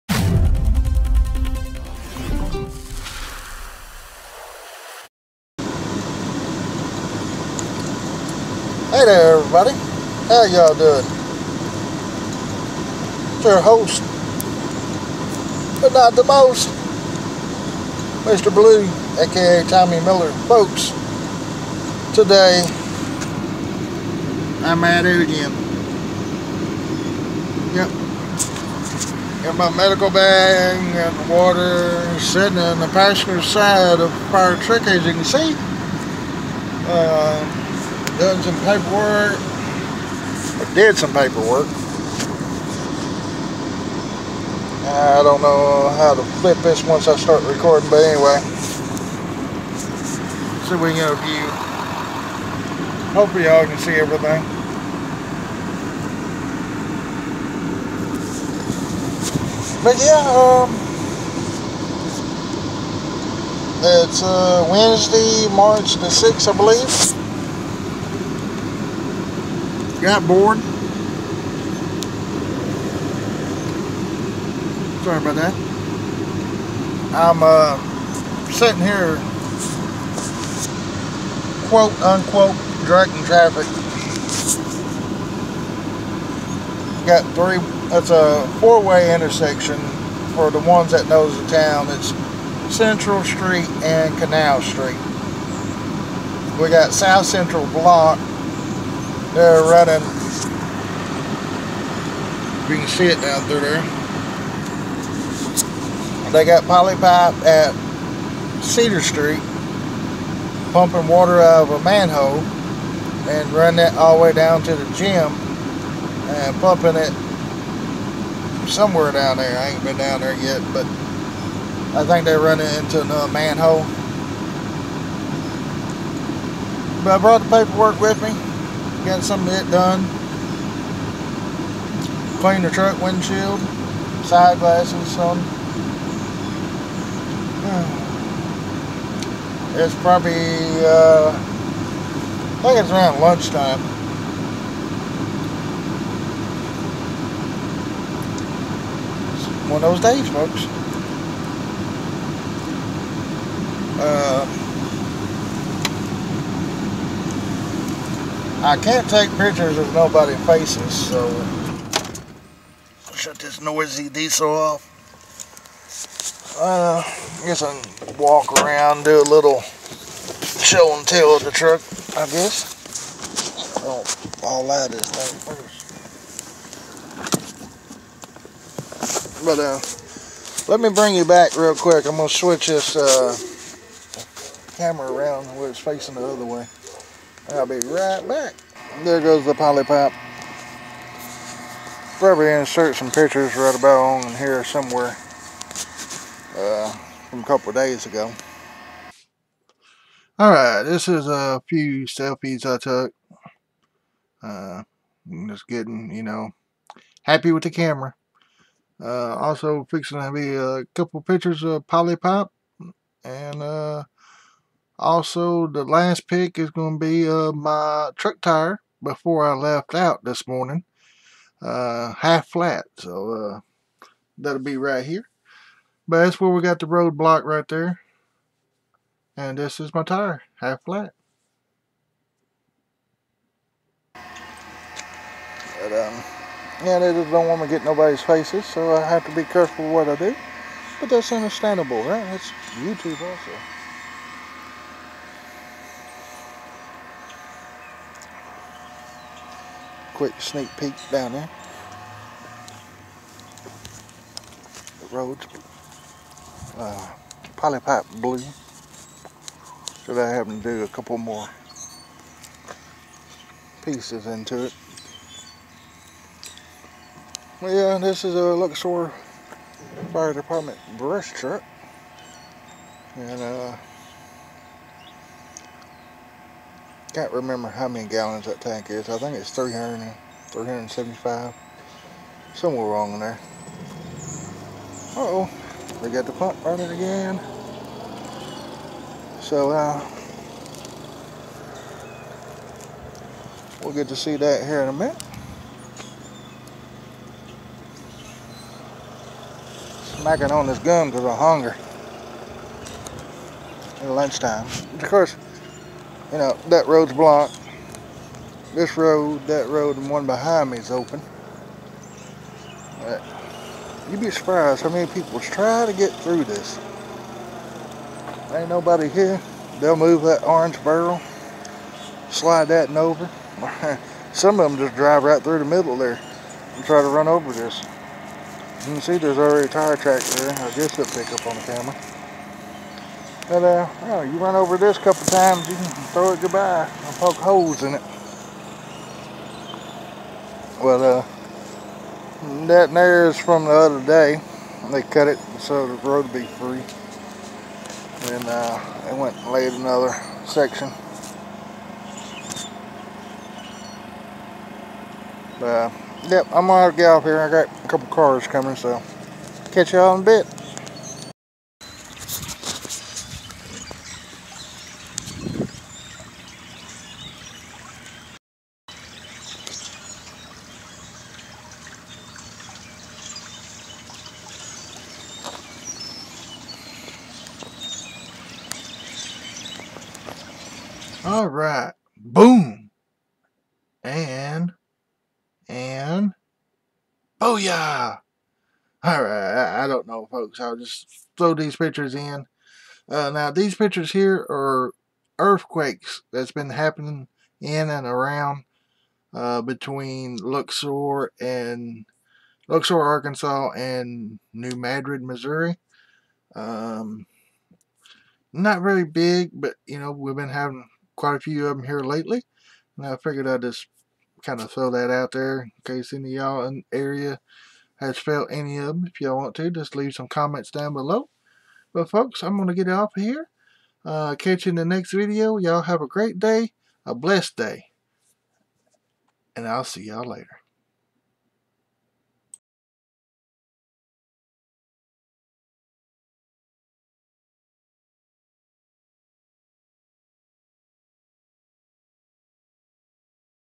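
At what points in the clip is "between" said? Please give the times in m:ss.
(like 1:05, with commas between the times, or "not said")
6:39.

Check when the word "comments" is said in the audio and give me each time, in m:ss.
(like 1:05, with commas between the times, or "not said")
7:00.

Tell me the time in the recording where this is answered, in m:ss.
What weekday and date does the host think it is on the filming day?
1:04.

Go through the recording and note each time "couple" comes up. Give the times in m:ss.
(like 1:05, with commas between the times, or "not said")
3:17, 3:30, 4:20, 5:35, 5:57.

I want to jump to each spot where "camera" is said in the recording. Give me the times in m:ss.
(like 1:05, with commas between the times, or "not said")
3:04, 3:27, 5:31.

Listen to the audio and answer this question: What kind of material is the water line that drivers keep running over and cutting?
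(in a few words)
Poly pipe.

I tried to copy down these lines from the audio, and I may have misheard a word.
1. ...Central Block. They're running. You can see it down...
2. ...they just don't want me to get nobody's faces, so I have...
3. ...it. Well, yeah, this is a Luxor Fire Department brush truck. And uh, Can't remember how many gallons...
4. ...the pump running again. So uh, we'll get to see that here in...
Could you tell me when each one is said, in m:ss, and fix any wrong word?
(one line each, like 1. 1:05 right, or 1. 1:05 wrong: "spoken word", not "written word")
1. 1:37 right
2. 3:56 right
3. 4:24 right
4. 4:46 right.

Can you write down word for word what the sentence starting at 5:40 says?
But, uh, that there is from the other day.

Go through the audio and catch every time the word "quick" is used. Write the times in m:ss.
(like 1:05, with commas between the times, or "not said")
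3:01, 4:10.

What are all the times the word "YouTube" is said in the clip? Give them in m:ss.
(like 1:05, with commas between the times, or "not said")
4:02.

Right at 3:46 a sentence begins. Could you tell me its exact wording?
But that's where we got the roadblock right there.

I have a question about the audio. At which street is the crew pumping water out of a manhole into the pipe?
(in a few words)
Cedar Street.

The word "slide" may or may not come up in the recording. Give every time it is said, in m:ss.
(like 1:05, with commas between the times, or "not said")
5:22.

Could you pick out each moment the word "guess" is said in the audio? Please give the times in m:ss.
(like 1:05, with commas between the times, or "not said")
2:47, 2:52, 5:30.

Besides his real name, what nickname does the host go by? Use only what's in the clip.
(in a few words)
Mr. Blue.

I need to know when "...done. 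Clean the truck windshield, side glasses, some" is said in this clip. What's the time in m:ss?
2:09.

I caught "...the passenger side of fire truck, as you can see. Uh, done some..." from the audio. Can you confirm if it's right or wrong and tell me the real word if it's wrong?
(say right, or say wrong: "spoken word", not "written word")
right.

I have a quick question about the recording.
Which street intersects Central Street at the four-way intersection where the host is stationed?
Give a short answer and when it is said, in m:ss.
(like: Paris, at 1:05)
Canal Street, at 1:34.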